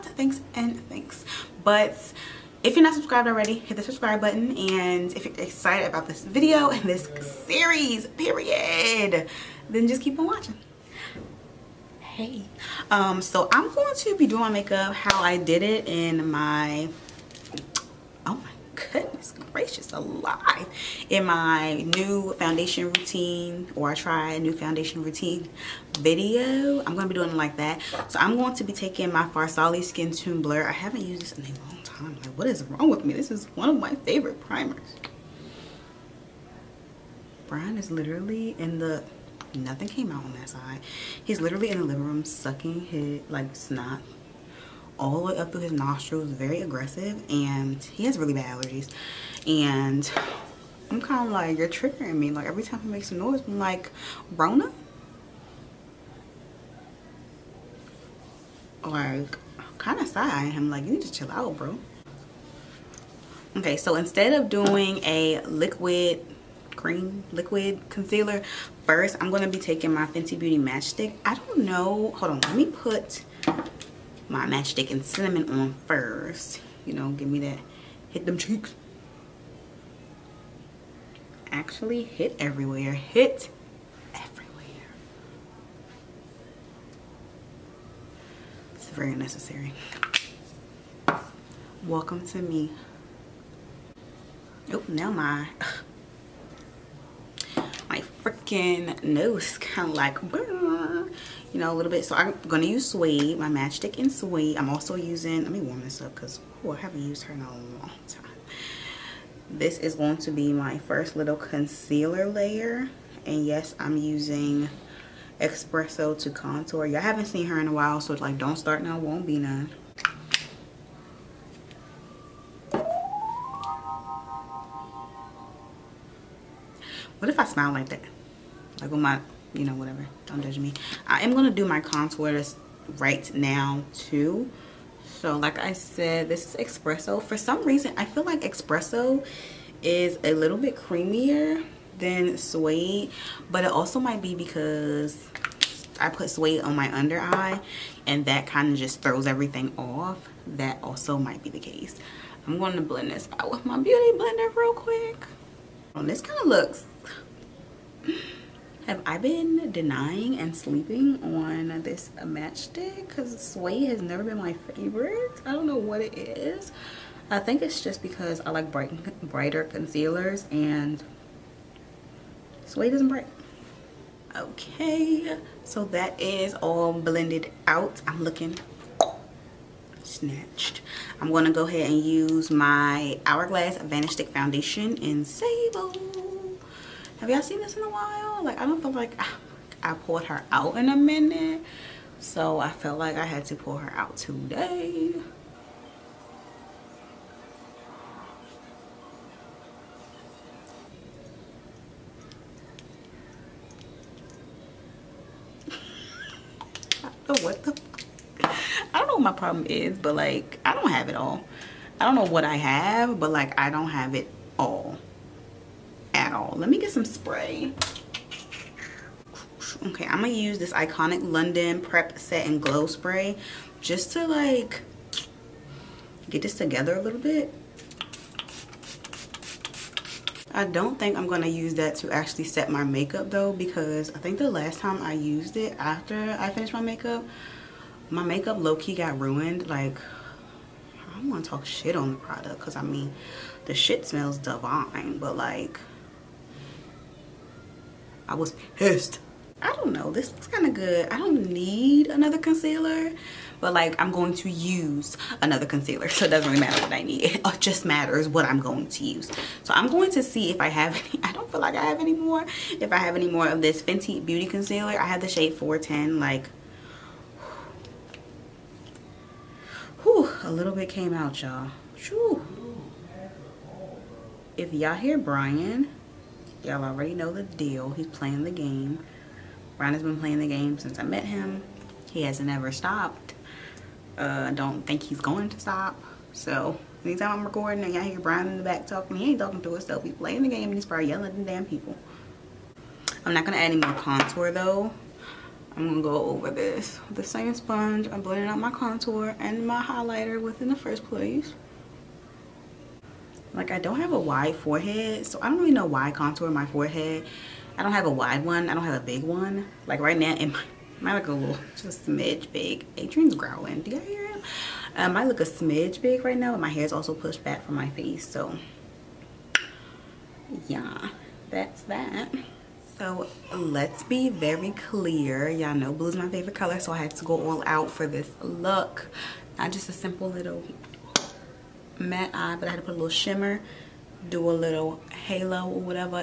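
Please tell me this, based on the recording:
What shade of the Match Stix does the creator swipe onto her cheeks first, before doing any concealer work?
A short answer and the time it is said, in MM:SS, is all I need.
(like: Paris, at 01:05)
cinnamon, at 01:15.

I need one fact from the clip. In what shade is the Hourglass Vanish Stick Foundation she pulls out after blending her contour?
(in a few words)
Sable.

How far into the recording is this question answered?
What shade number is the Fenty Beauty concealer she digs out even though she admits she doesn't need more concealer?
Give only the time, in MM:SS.
04:25.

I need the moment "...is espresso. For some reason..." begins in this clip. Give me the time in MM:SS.
02:16.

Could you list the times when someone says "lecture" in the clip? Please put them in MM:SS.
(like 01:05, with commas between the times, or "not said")
not said.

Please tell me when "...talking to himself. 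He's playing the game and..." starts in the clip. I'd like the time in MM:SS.
04:49.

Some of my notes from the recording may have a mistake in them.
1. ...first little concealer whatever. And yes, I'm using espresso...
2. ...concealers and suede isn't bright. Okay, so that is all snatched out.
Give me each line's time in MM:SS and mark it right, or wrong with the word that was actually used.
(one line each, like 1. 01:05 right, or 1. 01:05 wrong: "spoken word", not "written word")
1. 01:50 wrong: "layer", not "whatever"
2. 02:49 wrong: "blended", not "snatched".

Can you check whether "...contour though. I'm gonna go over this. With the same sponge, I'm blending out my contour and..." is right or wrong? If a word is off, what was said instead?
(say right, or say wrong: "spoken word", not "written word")
right.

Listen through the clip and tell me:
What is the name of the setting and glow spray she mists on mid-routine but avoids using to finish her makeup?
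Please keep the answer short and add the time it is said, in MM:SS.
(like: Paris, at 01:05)
Prep Set and Glow Spray, at 03:41.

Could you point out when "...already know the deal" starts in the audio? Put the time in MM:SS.
04:36.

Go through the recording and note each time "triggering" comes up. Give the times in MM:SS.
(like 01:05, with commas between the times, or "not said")
00:51.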